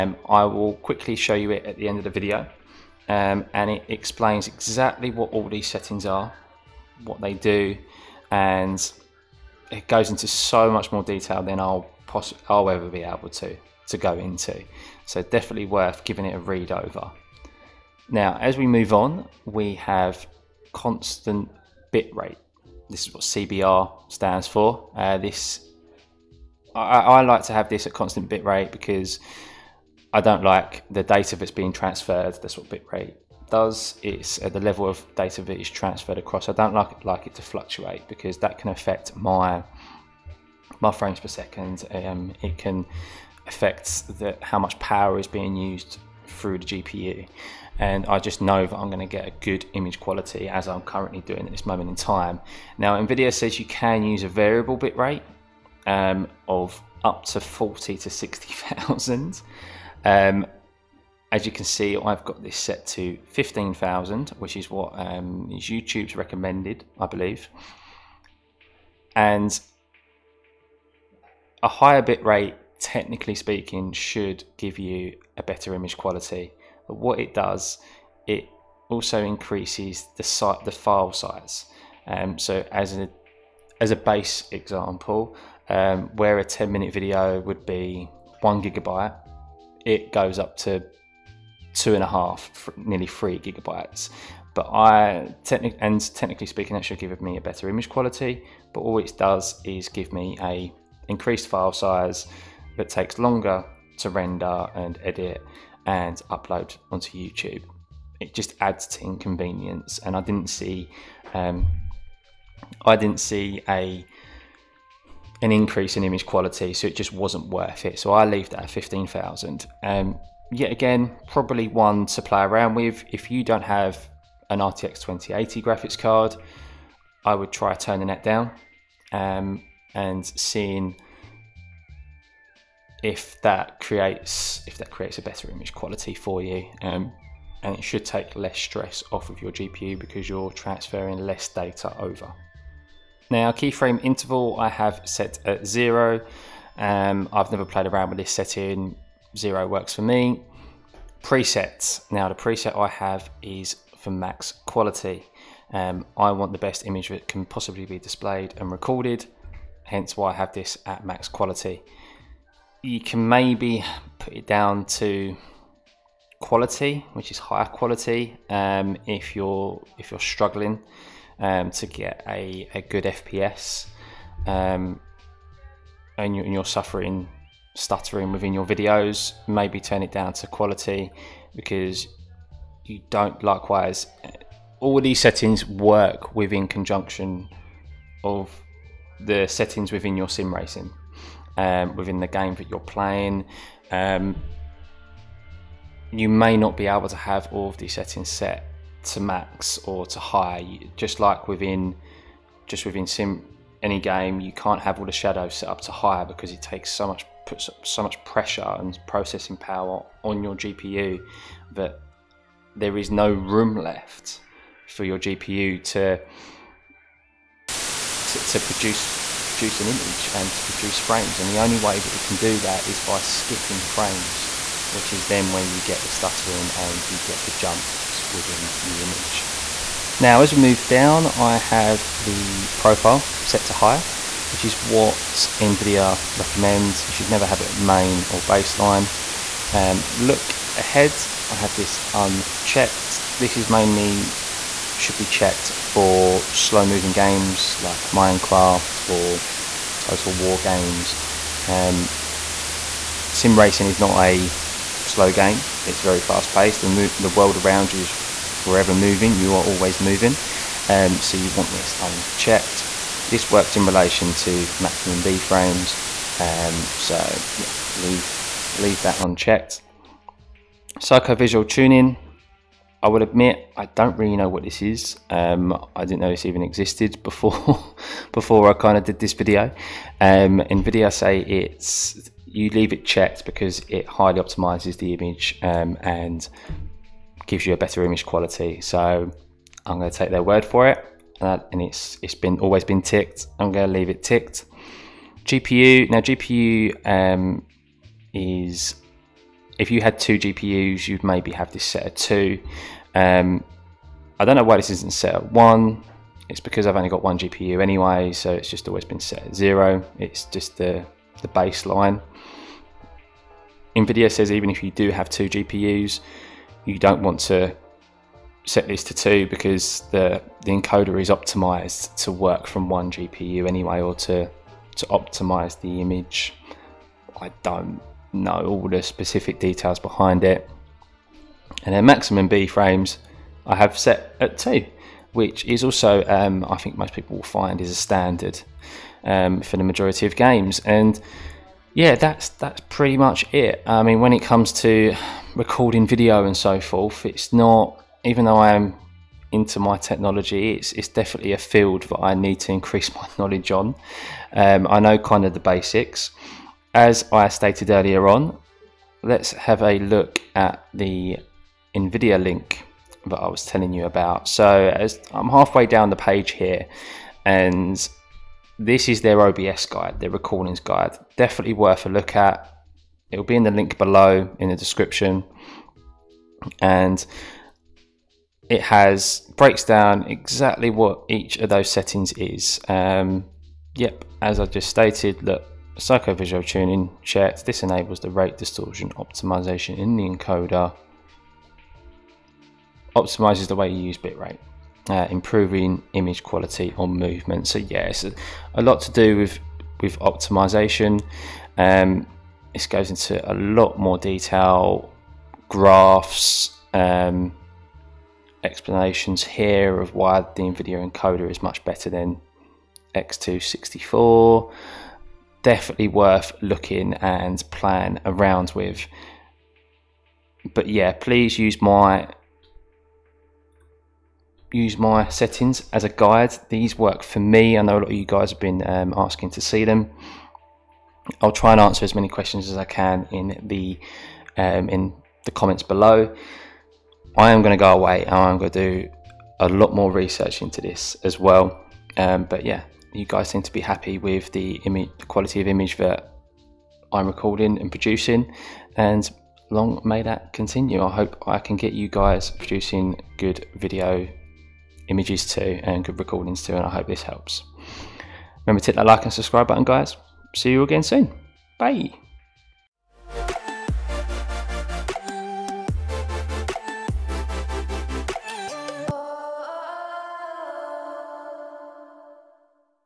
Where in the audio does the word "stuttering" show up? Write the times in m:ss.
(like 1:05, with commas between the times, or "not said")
2:57, 3:46.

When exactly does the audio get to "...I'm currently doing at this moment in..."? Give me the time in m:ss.
0:50.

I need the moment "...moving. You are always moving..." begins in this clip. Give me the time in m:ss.
4:18.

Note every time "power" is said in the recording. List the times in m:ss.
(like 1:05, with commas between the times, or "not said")
0:44, 3:29.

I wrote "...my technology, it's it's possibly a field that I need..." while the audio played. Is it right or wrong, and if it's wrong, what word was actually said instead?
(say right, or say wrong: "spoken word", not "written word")
wrong: "definitely", not "possibly".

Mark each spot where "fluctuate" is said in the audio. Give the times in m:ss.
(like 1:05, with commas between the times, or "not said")
0:37.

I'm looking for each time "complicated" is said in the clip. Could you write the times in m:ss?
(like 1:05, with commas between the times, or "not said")
not said.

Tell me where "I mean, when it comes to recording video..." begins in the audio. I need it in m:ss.
5:43.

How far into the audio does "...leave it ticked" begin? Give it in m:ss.
4:53.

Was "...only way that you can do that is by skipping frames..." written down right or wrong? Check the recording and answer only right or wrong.
right.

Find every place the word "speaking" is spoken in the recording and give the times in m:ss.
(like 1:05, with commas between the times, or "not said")
1:13, 1:36.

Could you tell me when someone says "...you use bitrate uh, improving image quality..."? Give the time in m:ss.
6:33.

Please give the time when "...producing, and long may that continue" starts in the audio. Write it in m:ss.
7:27.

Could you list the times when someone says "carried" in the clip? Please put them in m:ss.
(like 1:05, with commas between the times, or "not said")
not said.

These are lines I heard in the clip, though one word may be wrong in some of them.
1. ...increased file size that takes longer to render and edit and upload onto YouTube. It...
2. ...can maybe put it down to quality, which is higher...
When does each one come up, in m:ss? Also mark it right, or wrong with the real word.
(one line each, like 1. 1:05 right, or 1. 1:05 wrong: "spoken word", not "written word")
1. 1:41 right
2. 2:42 right.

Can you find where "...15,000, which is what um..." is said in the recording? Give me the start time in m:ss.
1:03.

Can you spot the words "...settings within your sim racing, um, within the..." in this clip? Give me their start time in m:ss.
3:09.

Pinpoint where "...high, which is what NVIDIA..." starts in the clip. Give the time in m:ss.
3:53.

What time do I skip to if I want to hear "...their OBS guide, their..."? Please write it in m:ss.
6:09.